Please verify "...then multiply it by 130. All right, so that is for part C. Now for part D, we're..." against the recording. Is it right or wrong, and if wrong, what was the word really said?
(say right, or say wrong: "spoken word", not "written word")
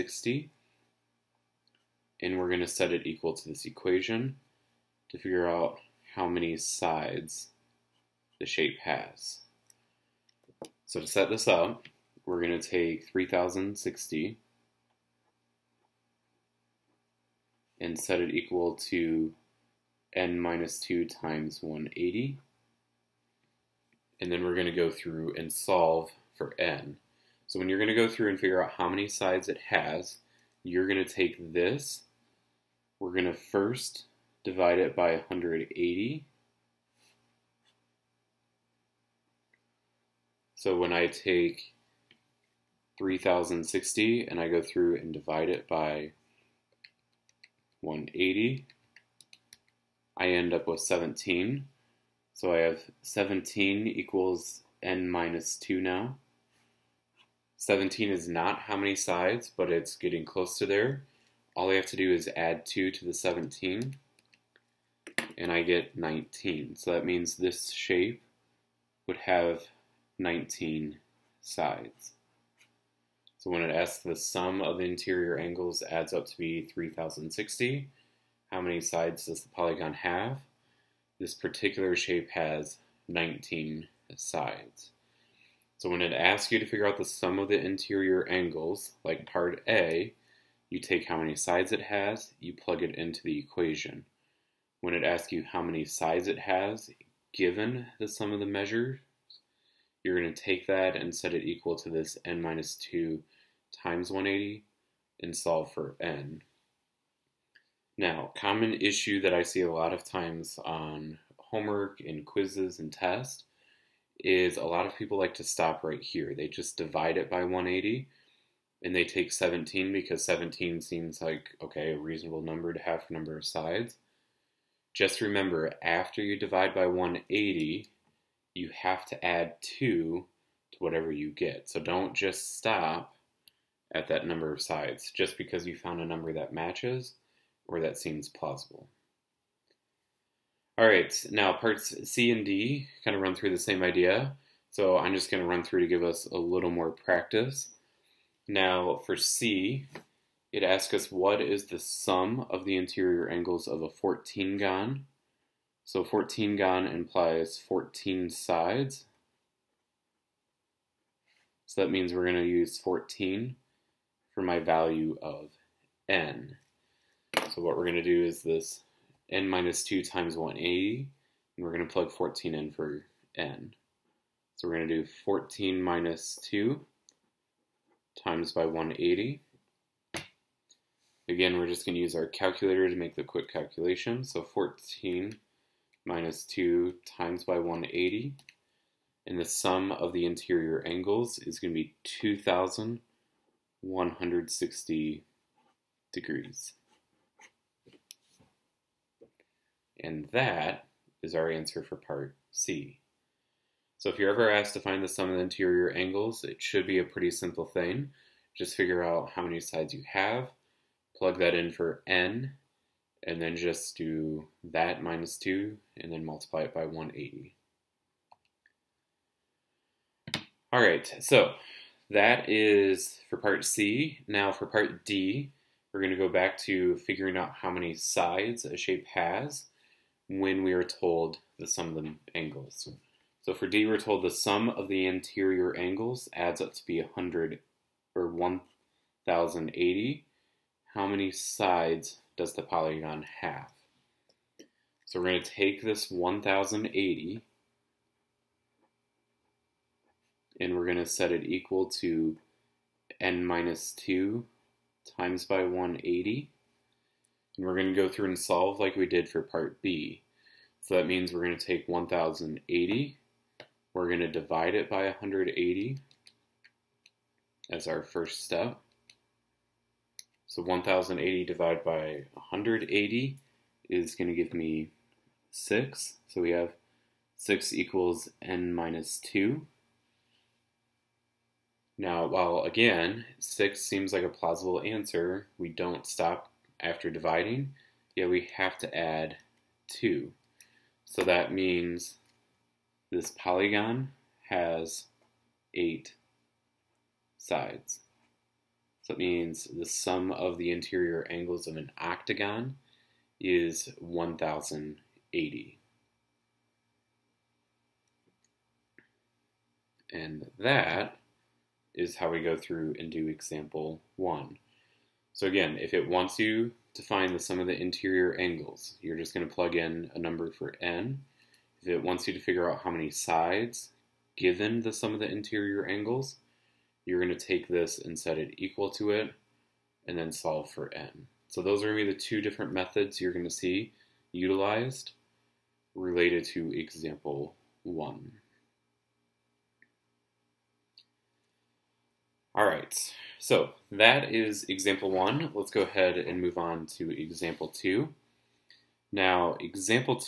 wrong: "180", not "130".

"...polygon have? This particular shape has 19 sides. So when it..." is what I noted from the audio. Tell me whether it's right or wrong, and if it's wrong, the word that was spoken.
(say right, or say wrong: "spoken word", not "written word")
right.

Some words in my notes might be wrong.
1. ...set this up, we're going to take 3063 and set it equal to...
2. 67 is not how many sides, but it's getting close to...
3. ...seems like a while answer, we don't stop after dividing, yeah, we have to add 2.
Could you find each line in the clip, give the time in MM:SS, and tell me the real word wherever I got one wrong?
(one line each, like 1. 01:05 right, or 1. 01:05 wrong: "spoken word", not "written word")
1. 00:11 wrong: "3060", not "3063"
2. 00:57 wrong: "17", not "67"
3. 04:43 wrong: "plausible", not "while".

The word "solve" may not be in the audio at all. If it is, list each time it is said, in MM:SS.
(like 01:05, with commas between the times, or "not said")
00:25, 01:45, 04:18, 05:30.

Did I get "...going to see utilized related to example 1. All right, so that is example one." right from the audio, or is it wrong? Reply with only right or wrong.
right.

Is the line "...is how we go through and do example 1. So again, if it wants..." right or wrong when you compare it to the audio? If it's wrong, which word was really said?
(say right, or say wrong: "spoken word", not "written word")
right.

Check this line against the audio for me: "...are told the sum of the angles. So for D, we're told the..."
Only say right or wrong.
right.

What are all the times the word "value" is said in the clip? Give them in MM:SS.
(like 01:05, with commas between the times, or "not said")
02:44.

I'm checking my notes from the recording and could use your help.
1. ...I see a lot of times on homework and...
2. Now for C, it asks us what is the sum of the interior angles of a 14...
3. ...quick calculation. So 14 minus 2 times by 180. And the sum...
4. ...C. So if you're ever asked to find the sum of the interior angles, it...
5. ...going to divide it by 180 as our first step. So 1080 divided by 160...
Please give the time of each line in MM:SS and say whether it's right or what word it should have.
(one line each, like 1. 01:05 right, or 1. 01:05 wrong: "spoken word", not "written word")
1. 01:49 right
2. 02:28 right
3. 03:03 right
4. 03:22 right
5. 04:24 wrong: "180", not "160".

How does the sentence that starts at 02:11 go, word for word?
So don't just stop at that number of sides just because you found a number that matches or that seems plausible.